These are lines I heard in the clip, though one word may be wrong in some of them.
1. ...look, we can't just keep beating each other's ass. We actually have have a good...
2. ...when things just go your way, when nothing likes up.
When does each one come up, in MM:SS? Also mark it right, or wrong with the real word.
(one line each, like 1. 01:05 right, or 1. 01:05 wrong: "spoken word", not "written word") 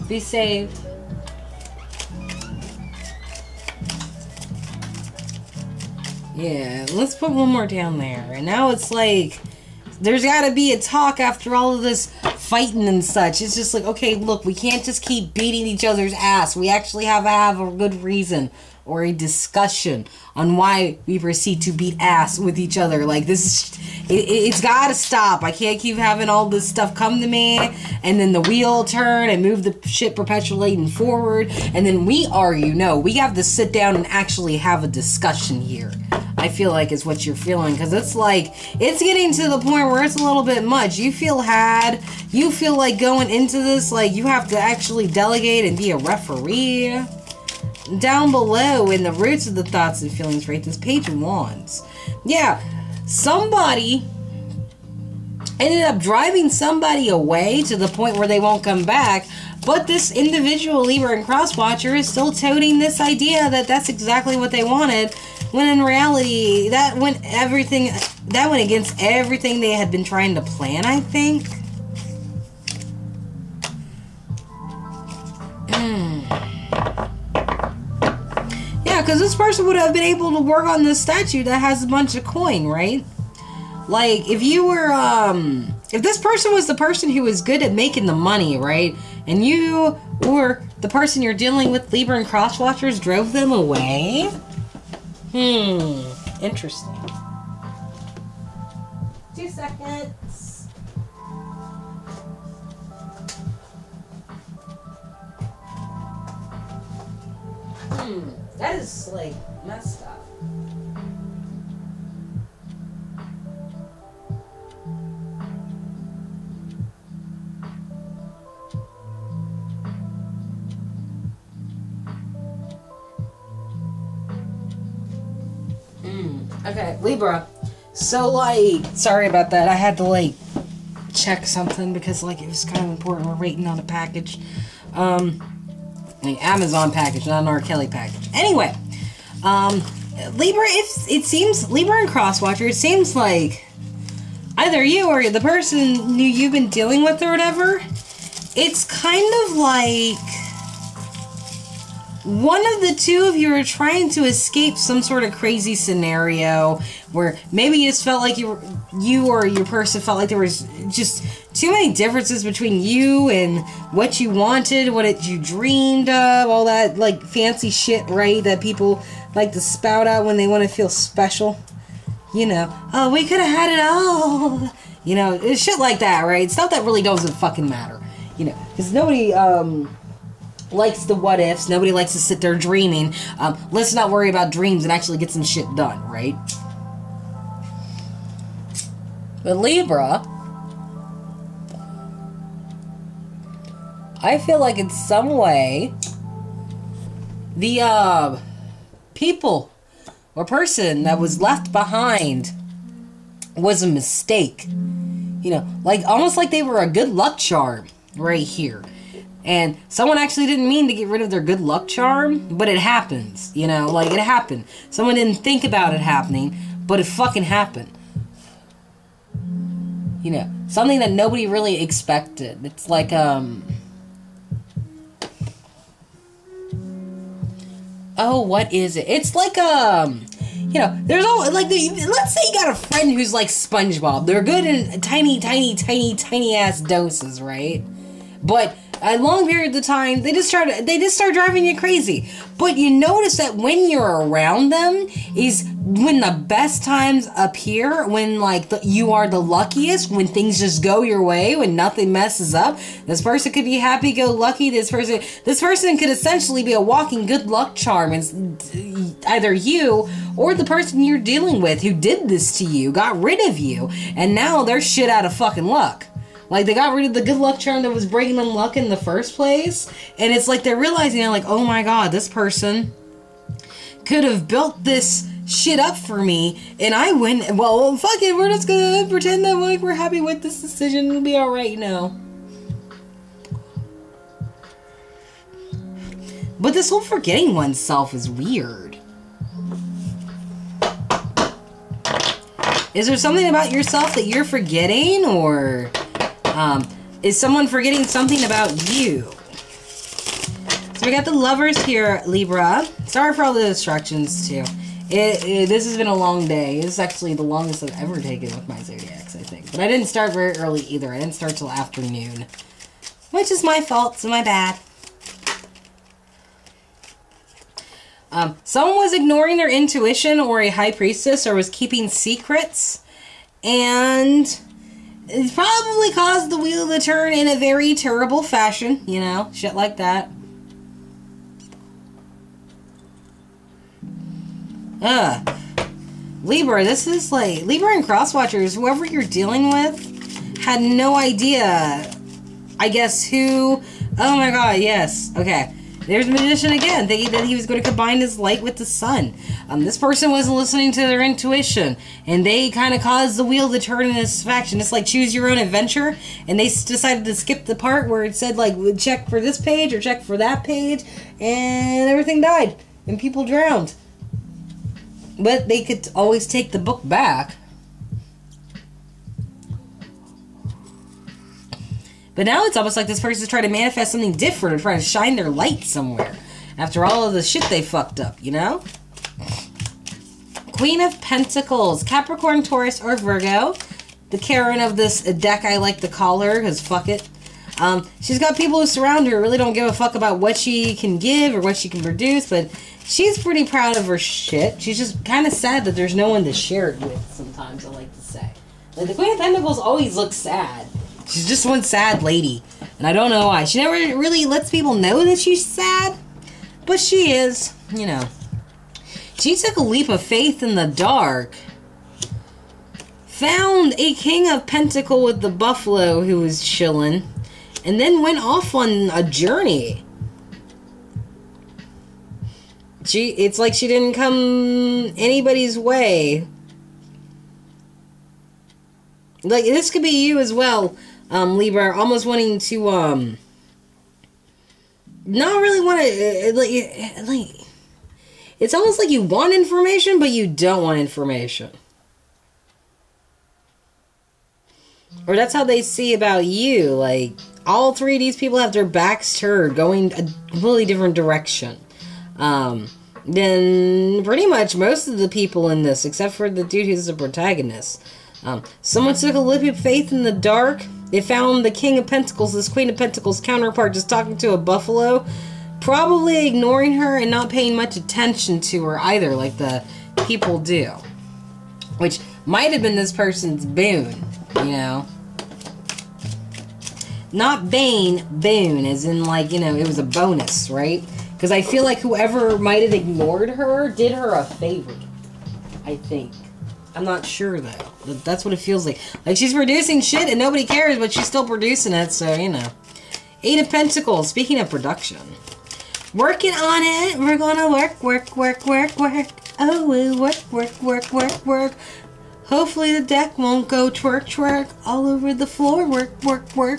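1. 00:14 right
2. 04:10 wrong: "messes", not "likes".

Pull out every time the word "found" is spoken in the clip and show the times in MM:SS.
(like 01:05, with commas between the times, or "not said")
06:53, 07:41.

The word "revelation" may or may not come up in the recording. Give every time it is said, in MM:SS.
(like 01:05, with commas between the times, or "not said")
not said.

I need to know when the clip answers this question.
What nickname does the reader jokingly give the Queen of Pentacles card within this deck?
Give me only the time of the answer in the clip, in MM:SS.
06:24.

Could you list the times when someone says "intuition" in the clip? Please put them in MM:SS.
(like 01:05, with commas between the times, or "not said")
05:19, 05:51.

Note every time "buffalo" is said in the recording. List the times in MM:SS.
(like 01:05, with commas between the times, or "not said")
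06:55, 07:44.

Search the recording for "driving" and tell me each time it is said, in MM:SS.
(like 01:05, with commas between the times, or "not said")
00:55, 04:01.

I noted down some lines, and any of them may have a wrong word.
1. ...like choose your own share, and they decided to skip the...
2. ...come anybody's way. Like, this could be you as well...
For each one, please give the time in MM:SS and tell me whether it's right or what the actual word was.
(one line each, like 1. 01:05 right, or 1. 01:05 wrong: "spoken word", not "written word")
1. 05:54 wrong: "adventure", not "share"
2. 07:04 right.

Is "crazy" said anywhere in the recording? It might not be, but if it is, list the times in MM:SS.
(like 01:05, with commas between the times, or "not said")
02:35, 04:01.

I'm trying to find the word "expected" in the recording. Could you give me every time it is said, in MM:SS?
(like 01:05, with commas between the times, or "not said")
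03:41.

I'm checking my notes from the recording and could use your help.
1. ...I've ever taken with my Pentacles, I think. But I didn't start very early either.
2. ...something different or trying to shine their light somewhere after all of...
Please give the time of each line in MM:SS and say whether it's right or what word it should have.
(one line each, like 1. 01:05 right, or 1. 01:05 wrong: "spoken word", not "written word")
1. 05:07 wrong: "Zodiacs", not "Pentacles"
2. 06:14 right.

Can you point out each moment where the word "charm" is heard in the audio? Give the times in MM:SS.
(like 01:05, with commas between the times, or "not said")
03:27, 03:31, 04:17, 04:27.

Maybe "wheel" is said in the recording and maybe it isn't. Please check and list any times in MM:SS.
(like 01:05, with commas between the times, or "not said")
00:28, 05:26, 05:53.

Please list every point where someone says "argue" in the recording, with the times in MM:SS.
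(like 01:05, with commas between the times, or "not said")
00:32.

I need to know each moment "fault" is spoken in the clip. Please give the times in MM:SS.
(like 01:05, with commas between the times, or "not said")
05:13.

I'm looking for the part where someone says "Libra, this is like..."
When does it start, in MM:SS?
05:36.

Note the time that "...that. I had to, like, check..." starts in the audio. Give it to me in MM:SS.
02:09.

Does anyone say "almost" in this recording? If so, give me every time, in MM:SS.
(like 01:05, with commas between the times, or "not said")
03:26, 06:12, 07:11, 07:18.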